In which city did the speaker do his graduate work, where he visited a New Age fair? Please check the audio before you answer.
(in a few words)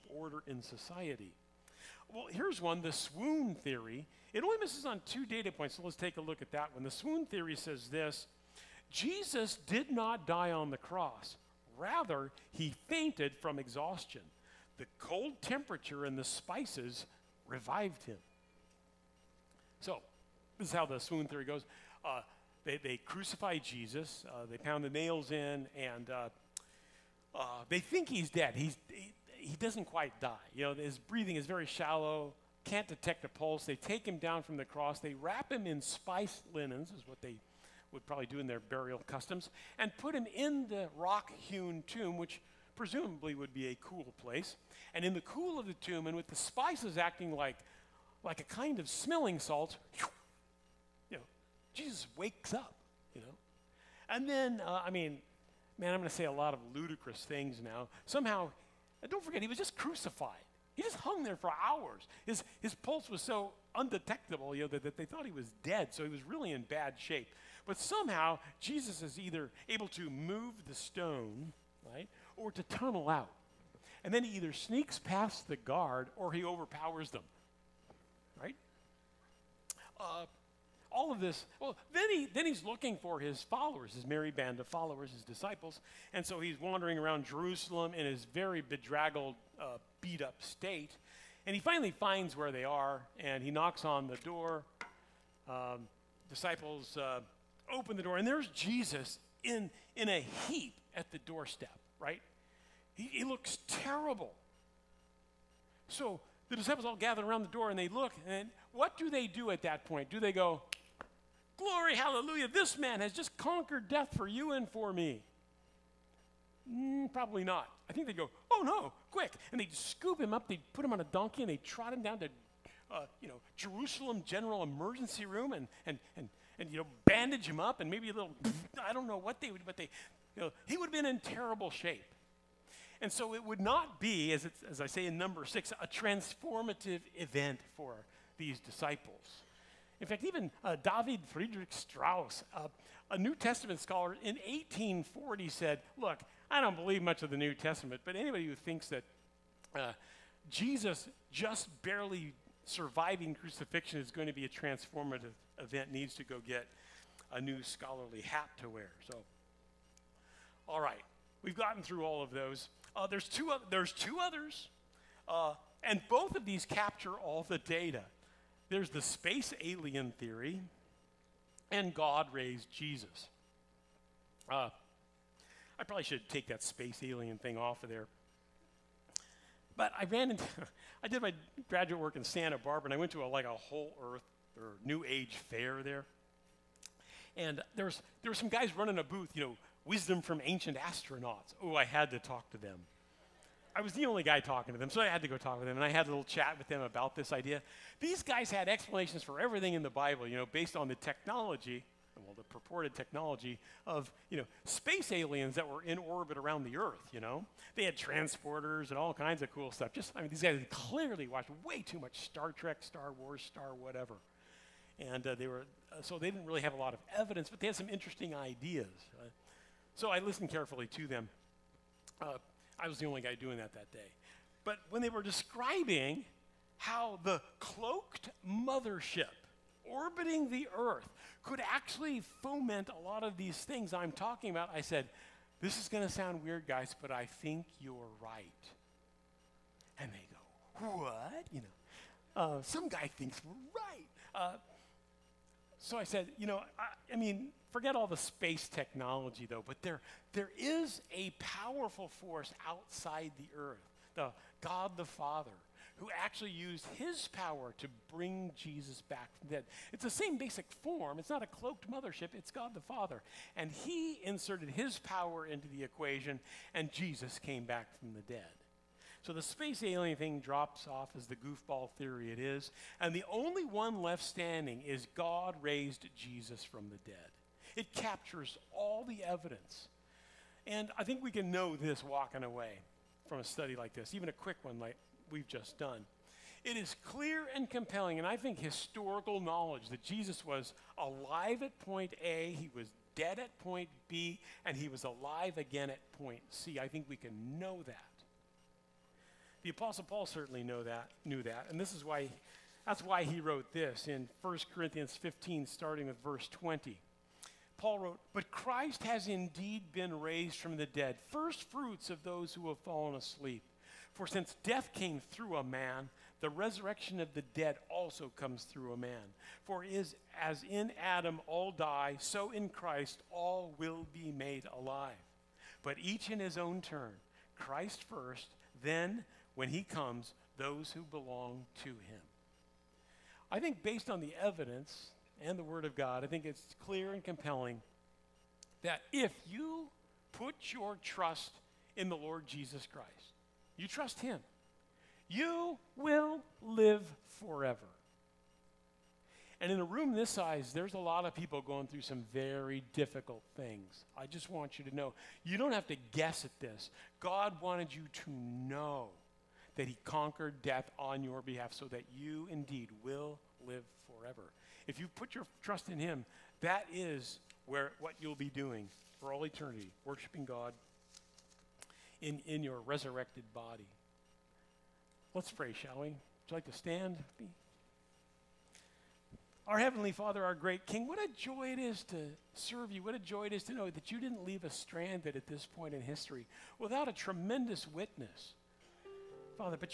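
Santa Barbara.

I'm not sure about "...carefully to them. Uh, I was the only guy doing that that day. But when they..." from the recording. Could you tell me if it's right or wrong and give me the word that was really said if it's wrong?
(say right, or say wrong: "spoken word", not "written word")
right.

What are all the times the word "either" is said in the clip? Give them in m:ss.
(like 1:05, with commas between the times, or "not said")
1:09, 1:14.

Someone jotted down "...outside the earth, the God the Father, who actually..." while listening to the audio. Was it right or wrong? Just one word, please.
right.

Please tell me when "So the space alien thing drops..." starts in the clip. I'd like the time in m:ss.
4:29.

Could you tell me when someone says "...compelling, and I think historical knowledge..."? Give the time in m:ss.
4:47.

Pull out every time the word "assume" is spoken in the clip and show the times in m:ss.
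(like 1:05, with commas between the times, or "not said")
not said.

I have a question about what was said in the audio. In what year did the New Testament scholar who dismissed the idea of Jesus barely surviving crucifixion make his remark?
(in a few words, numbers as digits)
1840.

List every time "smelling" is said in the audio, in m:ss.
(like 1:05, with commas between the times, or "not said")
0:48.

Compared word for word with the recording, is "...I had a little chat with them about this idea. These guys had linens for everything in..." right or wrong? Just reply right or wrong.
wrong.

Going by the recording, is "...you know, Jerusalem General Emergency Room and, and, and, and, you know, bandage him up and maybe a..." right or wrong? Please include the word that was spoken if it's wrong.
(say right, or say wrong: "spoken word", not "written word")
right.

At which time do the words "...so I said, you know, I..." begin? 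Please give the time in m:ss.
4:05.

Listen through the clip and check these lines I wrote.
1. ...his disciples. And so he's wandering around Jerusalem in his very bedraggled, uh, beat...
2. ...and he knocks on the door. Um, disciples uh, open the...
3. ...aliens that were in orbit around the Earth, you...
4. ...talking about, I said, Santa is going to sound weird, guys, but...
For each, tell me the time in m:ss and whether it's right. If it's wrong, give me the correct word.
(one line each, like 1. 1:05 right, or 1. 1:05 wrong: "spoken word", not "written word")
1. 1:25 right
2. 1:33 right
3. 3:25 right
4. 3:54 wrong: "This", not "Santa".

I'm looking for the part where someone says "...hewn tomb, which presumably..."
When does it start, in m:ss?
0:41.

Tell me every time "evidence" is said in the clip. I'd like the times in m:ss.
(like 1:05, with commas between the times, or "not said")
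3:37, 4:39, 5:34.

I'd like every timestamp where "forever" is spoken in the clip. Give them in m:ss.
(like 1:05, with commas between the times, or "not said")
5:47, 6:04.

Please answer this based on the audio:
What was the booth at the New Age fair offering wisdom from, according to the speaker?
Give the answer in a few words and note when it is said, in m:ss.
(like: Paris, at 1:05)
ancient astronauts, at 3:10.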